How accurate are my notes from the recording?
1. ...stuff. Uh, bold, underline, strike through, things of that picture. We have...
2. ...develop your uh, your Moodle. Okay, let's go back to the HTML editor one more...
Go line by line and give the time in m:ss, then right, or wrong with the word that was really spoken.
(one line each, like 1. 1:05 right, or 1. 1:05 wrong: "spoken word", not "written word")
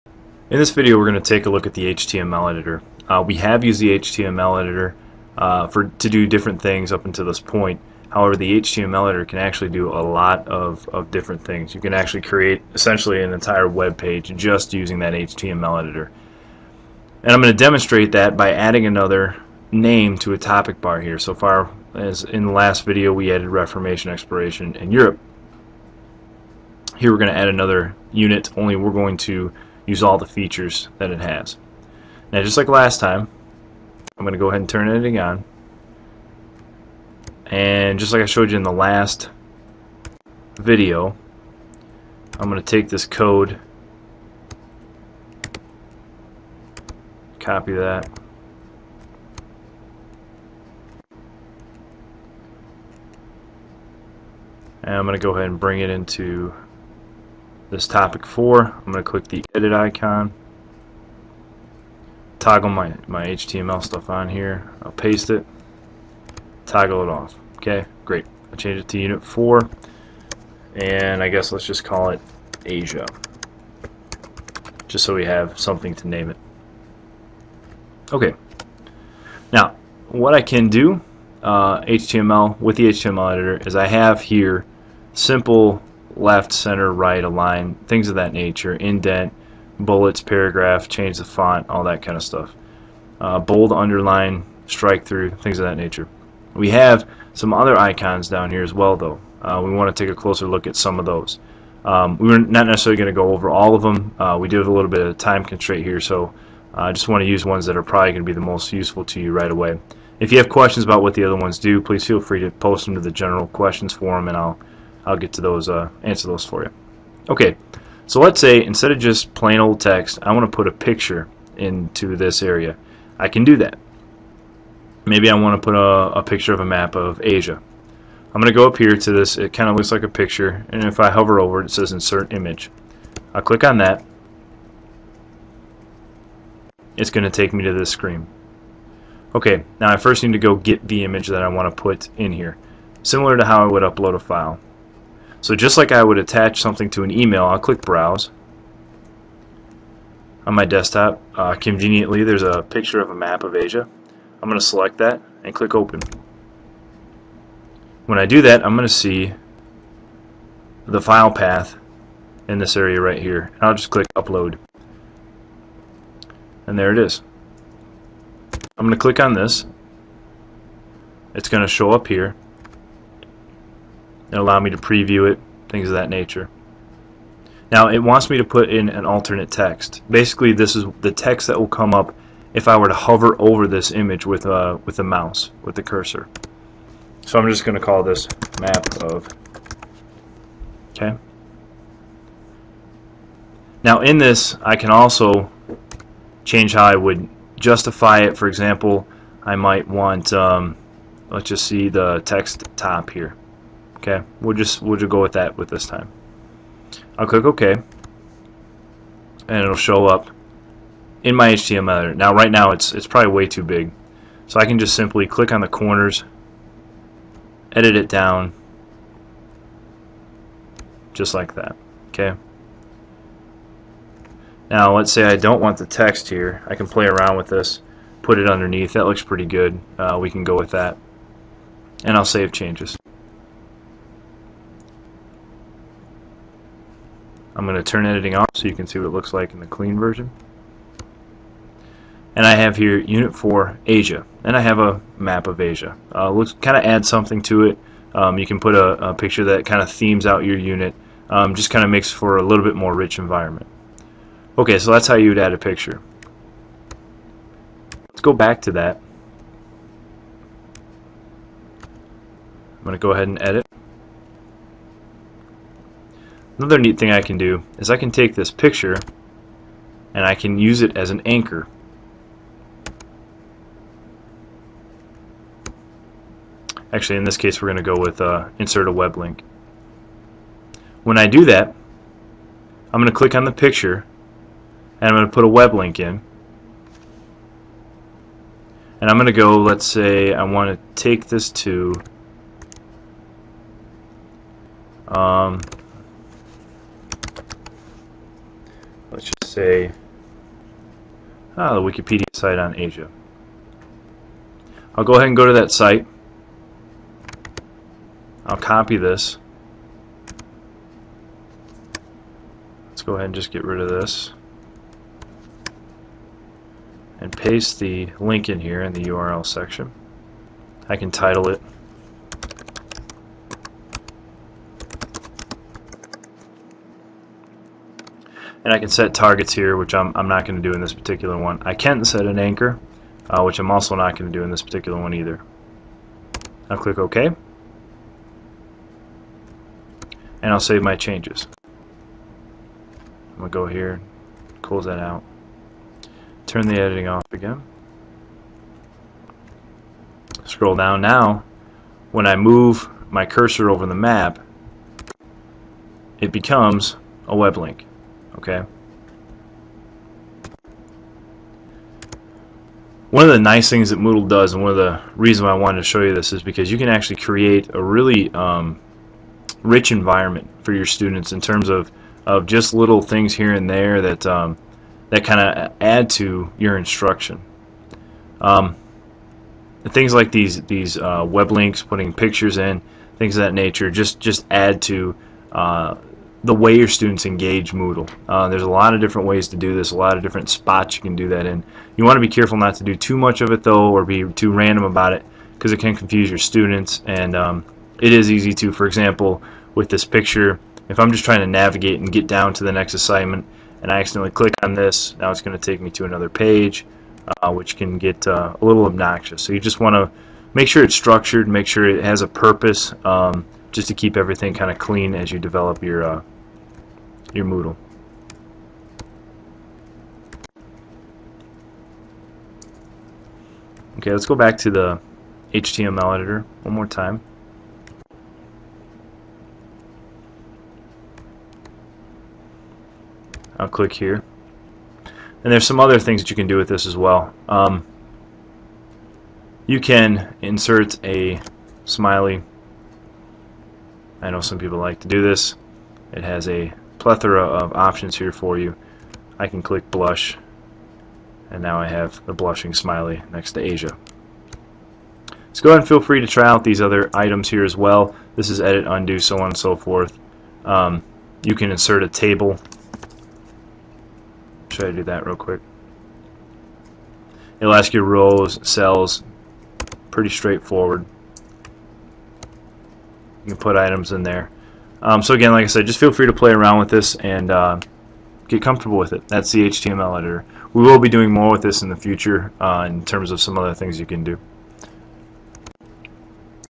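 1. 1:32 wrong: "nature", not "picture"
2. 6:55 right.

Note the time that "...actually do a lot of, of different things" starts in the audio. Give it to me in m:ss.
0:09.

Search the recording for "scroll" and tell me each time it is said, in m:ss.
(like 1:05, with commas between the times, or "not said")
5:50.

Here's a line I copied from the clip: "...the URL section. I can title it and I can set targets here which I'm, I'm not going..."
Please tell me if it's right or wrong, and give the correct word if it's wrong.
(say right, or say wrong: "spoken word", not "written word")
right.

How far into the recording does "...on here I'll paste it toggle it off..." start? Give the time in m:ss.
1:04.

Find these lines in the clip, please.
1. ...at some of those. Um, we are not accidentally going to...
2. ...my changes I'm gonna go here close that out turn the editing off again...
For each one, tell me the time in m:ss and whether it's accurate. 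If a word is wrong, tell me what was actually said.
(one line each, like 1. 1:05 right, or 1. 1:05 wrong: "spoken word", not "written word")
1. 1:40 wrong: "necessarily", not "accidentally"
2. 5:40 right.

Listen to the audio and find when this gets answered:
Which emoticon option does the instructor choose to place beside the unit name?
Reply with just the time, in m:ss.
7:29.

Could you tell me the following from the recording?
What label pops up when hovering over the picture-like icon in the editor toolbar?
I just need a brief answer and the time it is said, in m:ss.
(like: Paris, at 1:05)
Insert Image, at 2:11.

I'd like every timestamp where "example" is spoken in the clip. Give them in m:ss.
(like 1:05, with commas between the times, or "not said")
3:18, 6:38.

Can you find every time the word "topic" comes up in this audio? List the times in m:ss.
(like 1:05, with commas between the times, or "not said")
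0:20, 0:57.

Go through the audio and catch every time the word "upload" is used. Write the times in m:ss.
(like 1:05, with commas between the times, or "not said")
2:23, 2:44.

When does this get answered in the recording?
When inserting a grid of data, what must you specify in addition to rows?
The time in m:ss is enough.
7:48.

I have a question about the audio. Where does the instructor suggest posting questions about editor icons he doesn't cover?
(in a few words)
general questions forum.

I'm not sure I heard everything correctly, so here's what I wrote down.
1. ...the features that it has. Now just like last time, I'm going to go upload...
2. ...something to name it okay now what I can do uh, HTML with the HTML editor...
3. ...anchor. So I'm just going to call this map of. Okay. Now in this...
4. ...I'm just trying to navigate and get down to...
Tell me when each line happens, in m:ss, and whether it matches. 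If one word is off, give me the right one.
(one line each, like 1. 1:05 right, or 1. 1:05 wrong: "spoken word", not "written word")
1. 0:30 wrong: "ahead", not "upload"
2. 1:15 right
3. 3:05 wrong: "cursor", not "anchor"
4. 6:40 right.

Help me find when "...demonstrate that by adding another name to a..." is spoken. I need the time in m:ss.
0:17.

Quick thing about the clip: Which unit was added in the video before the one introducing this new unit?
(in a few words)
Reformation Exploration in Europe.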